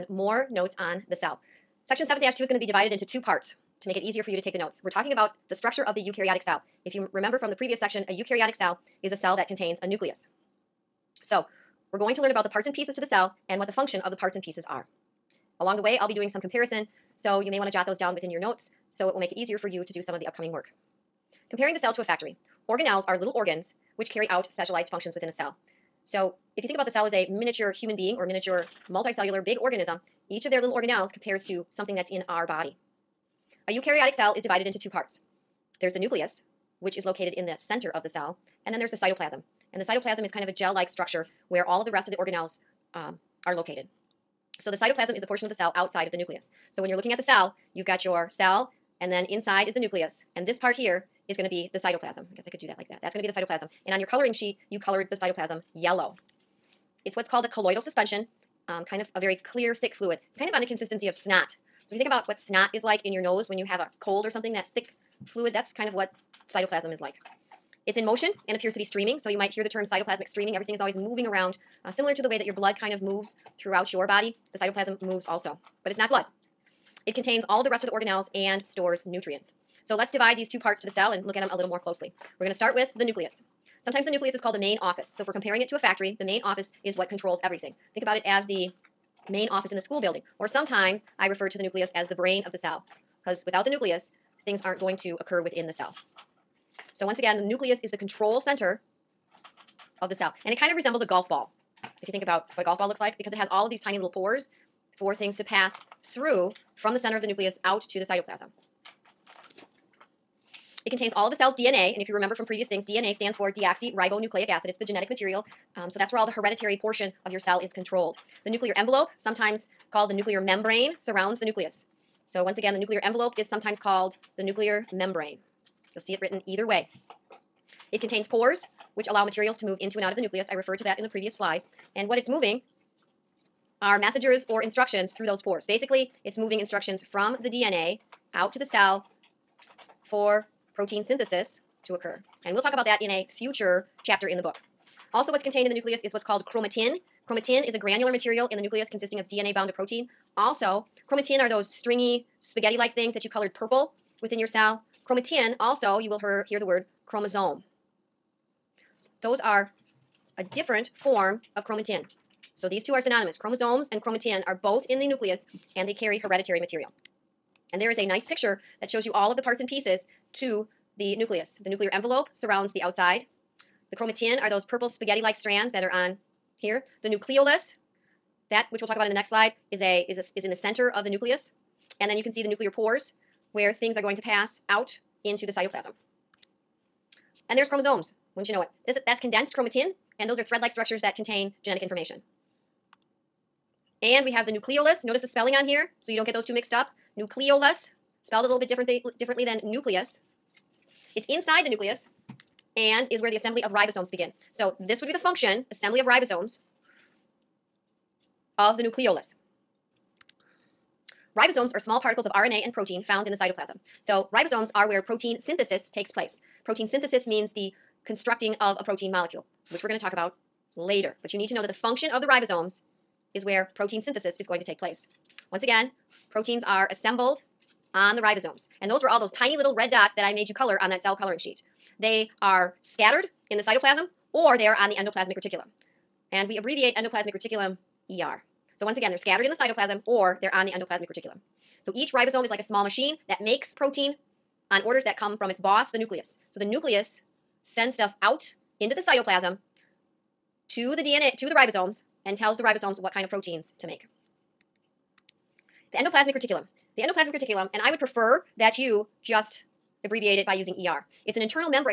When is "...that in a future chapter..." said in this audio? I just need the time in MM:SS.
02:22.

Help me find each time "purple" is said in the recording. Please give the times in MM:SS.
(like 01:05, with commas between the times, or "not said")
02:33, 02:54.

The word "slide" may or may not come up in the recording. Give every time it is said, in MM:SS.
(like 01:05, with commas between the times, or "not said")
02:11, 02:59.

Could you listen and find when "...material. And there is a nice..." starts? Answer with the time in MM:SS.
02:46.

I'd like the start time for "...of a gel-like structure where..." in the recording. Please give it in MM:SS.
00:40.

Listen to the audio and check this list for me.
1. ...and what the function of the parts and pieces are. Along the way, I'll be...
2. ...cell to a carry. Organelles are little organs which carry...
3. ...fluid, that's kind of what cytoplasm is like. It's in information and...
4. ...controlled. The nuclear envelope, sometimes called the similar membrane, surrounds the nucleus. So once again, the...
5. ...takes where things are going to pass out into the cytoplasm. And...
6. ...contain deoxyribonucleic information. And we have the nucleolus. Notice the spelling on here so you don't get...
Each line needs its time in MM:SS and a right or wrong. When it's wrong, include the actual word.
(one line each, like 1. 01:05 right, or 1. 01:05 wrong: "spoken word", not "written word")
1. 00:13 right
2. 00:21 wrong: "factory", not "carry"
3. 01:05 wrong: "motion", not "information"
4. 01:57 wrong: "nuclear", not "similar"
5. 03:02 wrong: "pores", not "takes"
6. 03:11 wrong: "genetic", not "deoxyribonucleic".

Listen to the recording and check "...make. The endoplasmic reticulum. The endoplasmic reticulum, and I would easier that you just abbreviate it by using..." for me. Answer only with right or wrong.
wrong.